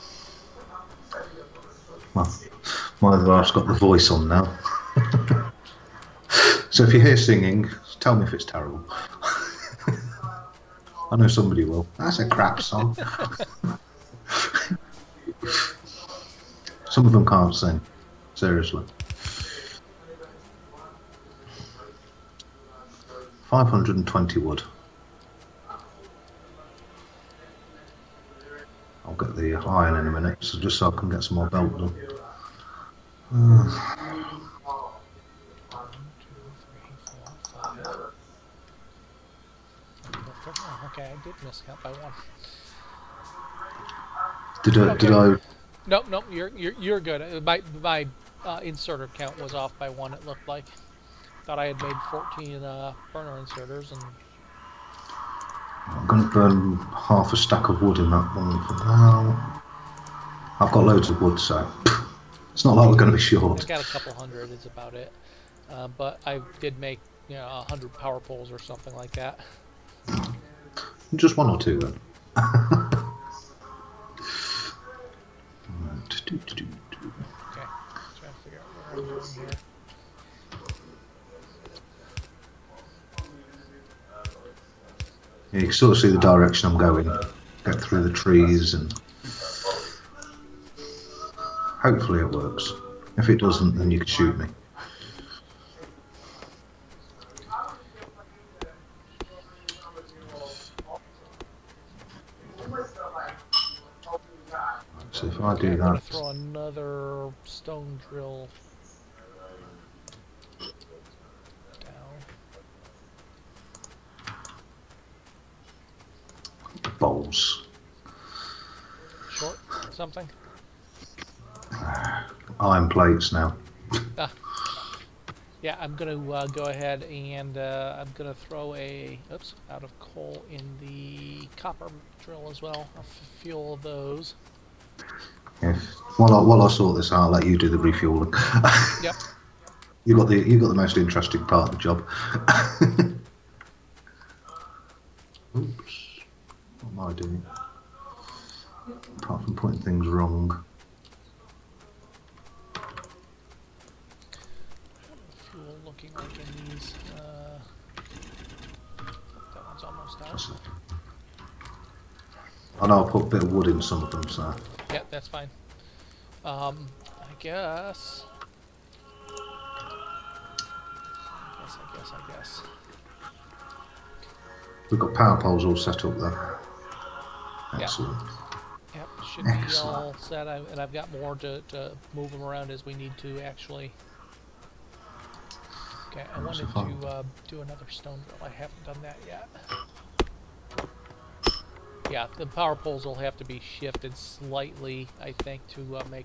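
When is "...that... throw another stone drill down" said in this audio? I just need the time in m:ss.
1:45.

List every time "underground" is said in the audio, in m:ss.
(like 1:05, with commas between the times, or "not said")
not said.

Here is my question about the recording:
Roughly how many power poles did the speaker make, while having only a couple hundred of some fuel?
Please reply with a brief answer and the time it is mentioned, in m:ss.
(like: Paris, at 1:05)
100, at 1:07.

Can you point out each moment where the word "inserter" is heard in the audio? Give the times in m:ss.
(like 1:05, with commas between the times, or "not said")
0:48, 0:53.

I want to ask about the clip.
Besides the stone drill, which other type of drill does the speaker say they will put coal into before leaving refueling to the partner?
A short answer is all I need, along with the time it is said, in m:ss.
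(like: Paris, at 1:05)
copper drill, at 2:11.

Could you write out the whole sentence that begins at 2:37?
Uh, I know I put a bit of wood in some of them, so that's fine.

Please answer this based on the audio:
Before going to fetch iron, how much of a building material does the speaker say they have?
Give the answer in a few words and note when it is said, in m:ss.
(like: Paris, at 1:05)
520, at 0:23.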